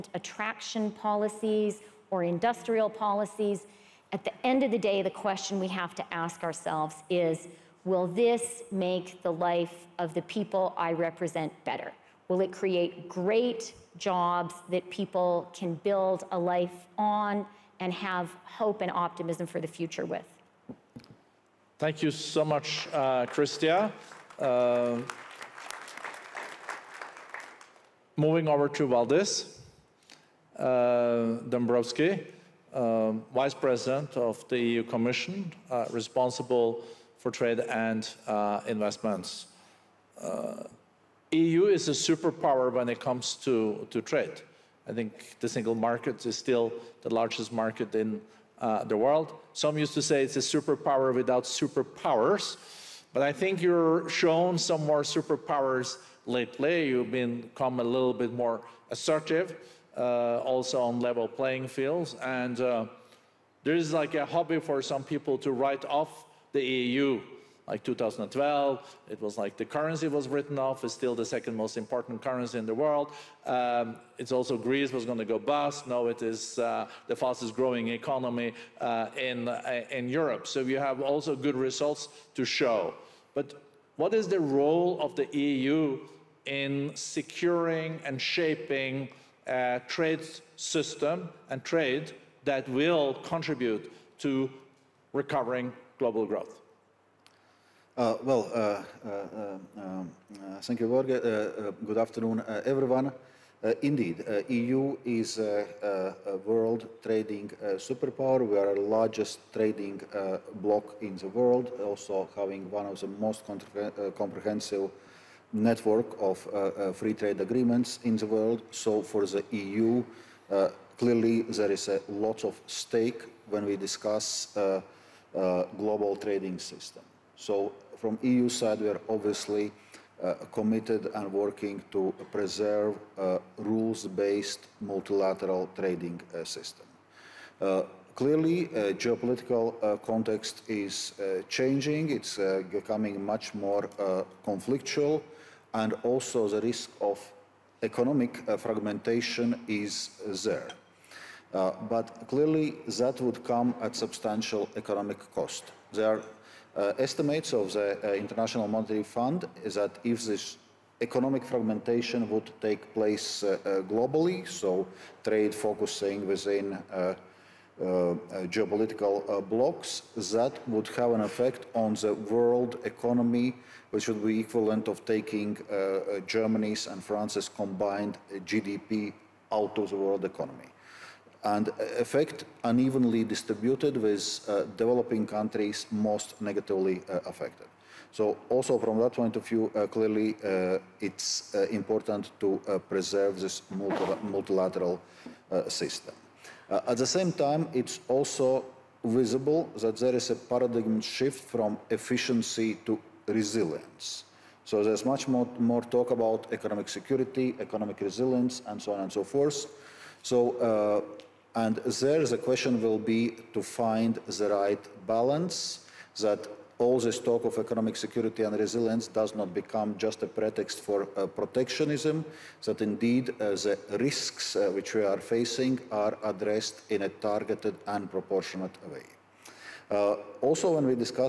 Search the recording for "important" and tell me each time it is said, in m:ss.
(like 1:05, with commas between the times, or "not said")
1:11, 3:11.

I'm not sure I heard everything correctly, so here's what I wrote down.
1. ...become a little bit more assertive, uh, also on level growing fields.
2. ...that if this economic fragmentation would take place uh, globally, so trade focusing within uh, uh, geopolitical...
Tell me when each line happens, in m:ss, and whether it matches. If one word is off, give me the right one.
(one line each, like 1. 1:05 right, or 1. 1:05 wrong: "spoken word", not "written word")
1. 0:57 wrong: "playing", not "growing"
2. 2:39 right.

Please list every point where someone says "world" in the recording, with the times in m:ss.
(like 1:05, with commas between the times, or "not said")
0:48, 1:12, 1:46, 1:51, 1:58, 2:52, 2:59.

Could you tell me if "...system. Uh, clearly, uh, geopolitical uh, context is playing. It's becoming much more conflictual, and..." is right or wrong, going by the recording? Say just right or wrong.
wrong.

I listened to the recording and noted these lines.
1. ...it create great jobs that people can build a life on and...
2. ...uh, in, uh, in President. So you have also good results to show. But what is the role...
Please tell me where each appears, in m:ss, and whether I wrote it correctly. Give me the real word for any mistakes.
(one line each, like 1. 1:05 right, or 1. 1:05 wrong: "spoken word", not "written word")
1. 0:12 right
2. 1:18 wrong: "Europe", not "President".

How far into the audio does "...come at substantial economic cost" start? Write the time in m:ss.
2:33.